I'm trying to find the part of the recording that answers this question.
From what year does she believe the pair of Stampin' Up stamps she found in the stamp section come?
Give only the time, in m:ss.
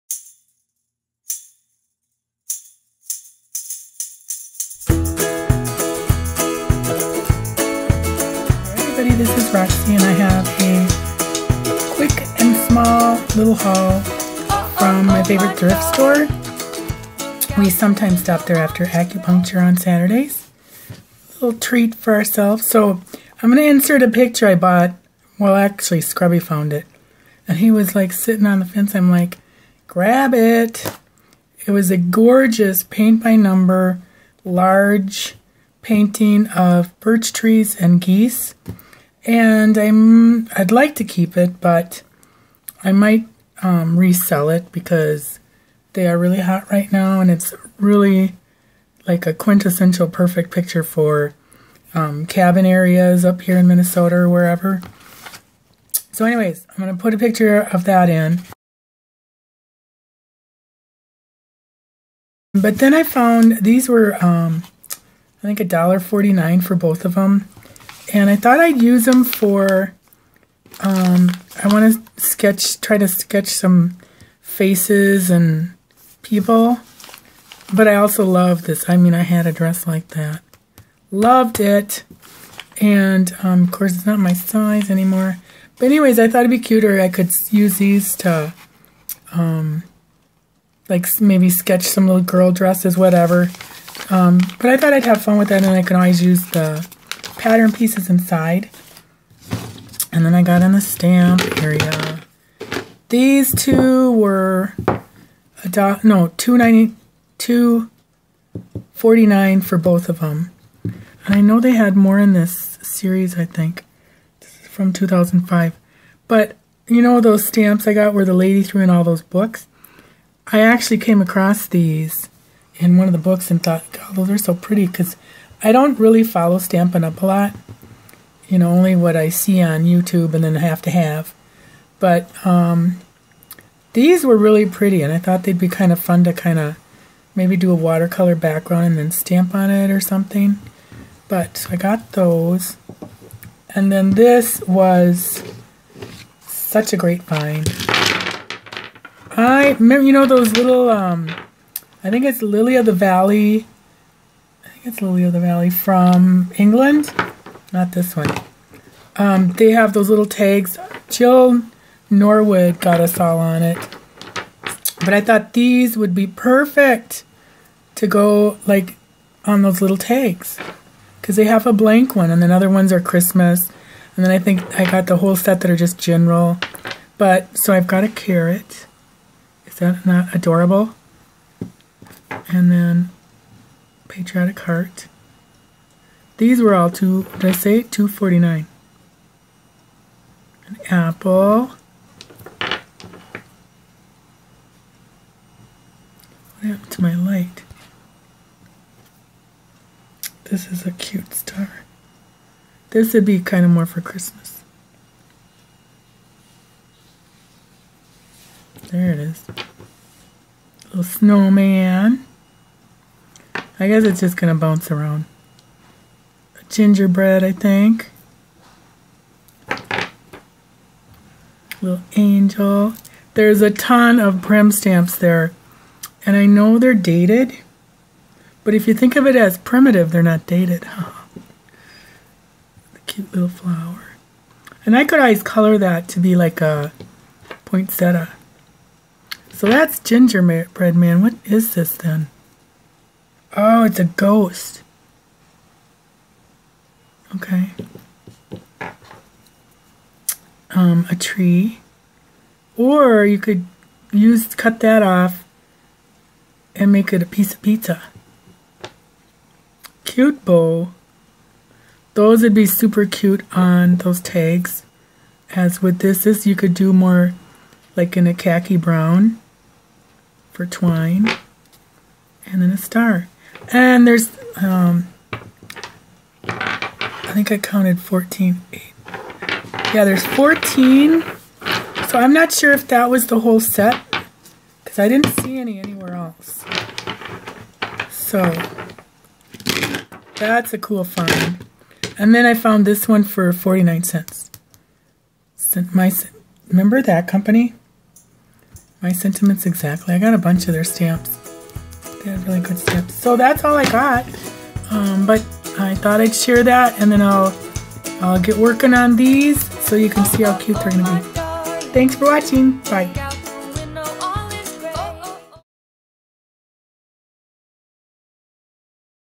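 1:54.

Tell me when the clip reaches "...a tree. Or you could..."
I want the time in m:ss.
4:11.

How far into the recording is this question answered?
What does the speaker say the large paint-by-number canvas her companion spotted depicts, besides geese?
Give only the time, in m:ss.
0:36.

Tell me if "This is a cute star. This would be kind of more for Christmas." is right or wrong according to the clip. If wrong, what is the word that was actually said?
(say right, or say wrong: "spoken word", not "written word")
right.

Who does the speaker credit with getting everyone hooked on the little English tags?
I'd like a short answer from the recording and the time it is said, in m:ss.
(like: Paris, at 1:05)
Jill Norwood, at 2:41.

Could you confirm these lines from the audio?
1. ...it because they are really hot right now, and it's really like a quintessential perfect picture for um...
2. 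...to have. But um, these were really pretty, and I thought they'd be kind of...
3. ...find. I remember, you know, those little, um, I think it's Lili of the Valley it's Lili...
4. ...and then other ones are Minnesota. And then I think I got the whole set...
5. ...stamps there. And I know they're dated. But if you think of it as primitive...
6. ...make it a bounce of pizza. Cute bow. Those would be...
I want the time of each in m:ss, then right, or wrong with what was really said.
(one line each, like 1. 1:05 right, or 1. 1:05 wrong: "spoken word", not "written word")
1. 0:44 right
2. 2:10 right
3. 2:27 right
4. 2:52 wrong: "Christmas", not "Minnesota"
5. 3:44 right
6. 4:16 wrong: "piece", not "bounce".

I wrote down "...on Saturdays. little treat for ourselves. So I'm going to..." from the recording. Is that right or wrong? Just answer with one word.
right.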